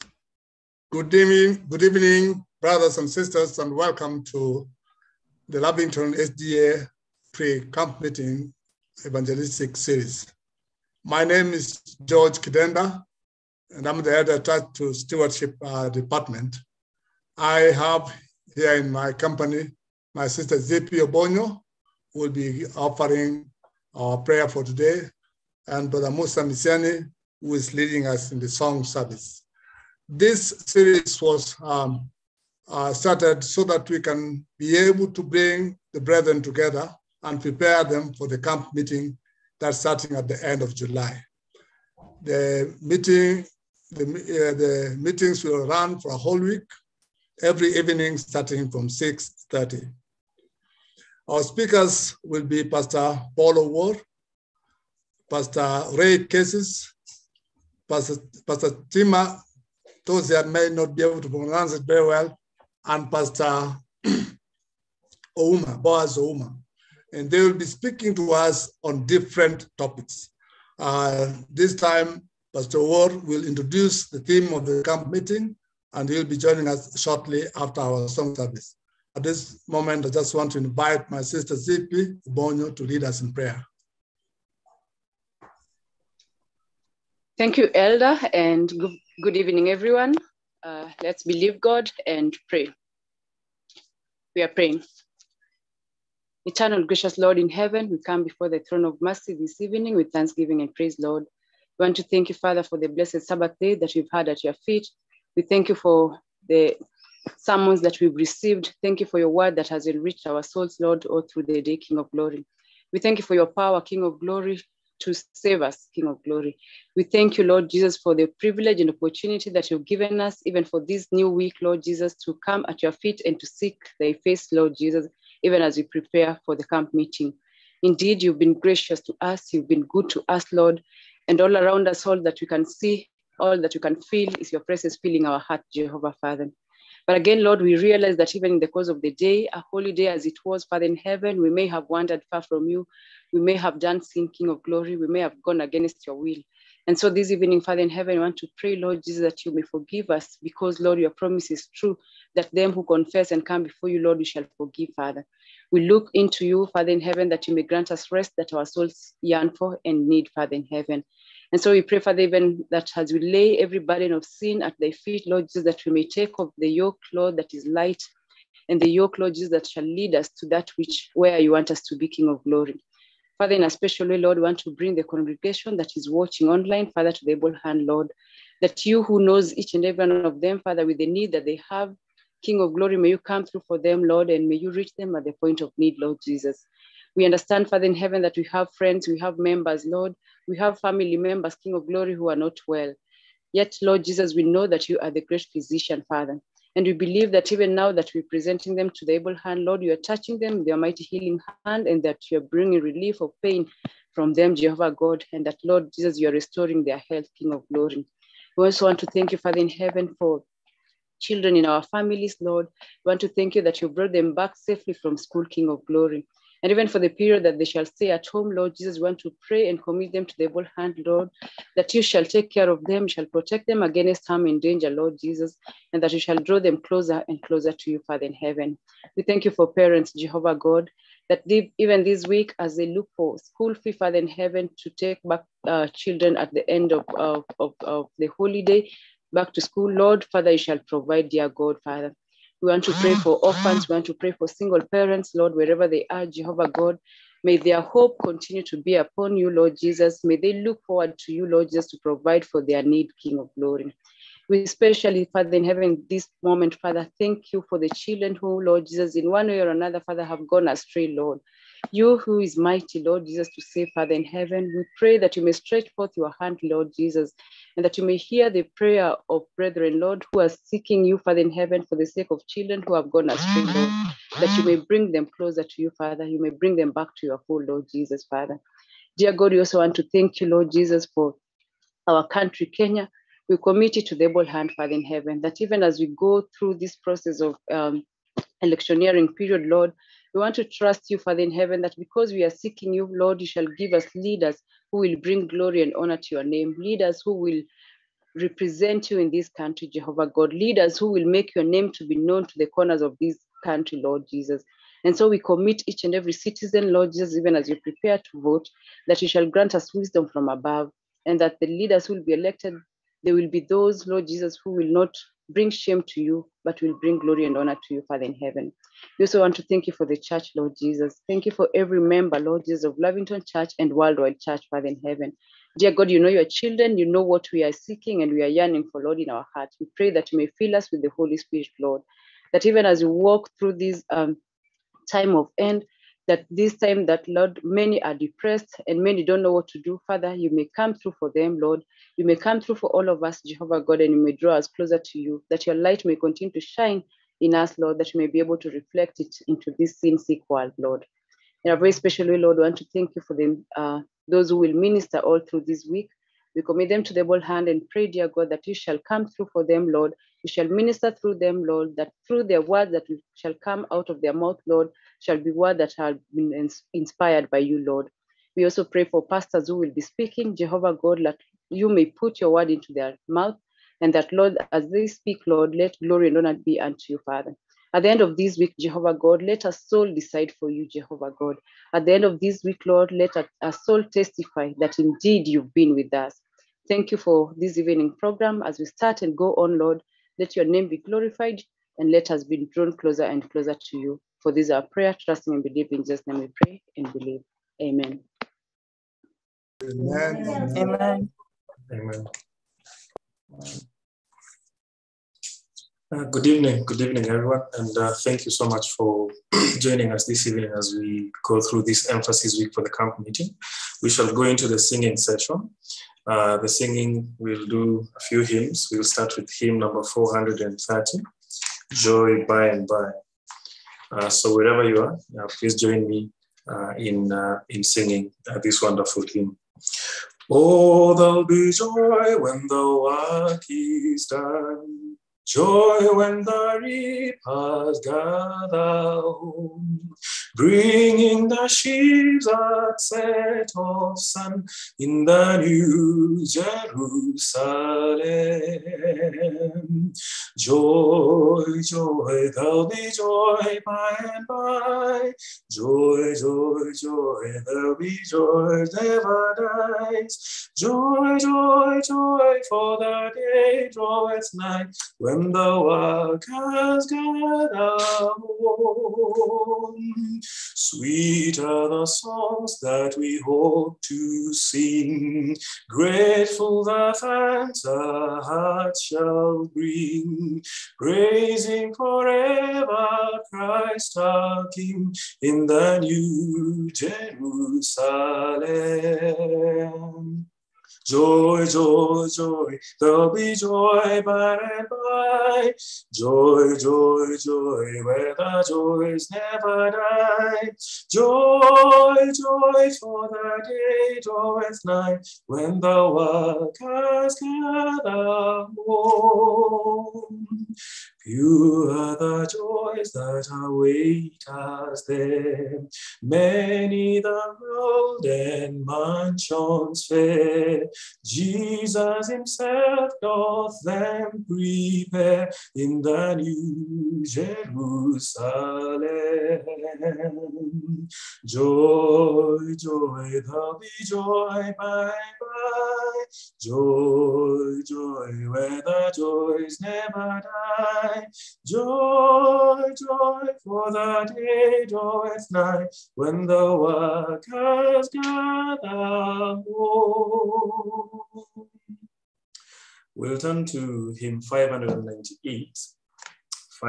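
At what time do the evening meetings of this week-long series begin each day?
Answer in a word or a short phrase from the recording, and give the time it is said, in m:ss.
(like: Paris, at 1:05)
6.30, at 0:48.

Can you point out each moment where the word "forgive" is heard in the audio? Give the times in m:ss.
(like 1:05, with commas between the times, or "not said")
2:29, 2:34.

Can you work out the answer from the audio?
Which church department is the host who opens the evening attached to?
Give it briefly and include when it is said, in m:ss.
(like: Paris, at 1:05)
Stewardship, at 0:14.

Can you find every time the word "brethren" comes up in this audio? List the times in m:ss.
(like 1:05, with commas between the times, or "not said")
0:35, 4:29.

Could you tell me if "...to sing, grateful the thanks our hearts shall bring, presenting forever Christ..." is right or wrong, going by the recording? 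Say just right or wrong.
wrong.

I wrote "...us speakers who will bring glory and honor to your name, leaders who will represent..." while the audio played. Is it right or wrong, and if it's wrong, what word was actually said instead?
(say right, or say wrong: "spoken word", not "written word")
wrong: "leaders", not "speakers".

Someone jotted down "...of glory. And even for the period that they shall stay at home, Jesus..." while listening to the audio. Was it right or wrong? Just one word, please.
wrong.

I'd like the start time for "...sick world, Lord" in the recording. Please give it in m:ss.
5:50.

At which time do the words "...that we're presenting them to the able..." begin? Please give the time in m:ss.
3:17.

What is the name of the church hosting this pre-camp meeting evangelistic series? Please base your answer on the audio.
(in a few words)
Lavington SDA.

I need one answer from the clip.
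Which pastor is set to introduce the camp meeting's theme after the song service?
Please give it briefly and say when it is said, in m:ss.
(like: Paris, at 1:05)
Pastor Ward, at 1:12.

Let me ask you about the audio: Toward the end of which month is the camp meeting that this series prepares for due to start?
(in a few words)
July.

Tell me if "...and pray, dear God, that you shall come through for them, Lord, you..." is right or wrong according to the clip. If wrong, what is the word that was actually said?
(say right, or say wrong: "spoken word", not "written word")
right.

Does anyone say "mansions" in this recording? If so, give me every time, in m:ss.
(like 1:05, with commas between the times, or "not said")
8:38.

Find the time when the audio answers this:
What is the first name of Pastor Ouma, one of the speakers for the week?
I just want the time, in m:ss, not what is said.
1:05.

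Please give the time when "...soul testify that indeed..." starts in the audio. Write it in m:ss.
6:23.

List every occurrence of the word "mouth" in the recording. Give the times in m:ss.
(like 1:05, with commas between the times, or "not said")
6:04, 6:13.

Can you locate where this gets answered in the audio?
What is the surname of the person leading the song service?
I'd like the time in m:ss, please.
0:26.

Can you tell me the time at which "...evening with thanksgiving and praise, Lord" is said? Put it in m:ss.
1:39.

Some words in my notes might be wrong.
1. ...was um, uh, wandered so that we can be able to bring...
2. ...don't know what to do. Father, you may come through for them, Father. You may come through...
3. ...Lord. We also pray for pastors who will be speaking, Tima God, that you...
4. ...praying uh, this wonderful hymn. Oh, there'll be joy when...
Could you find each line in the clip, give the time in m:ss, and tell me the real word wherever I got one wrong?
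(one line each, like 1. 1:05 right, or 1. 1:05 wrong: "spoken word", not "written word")
1. 0:31 wrong: "started", not "wandered"
2. 5:39 wrong: "Lord", not "Father"
3. 6:07 wrong: "Jehovah", not "Tima"
4. 7:07 wrong: "singing", not "praying".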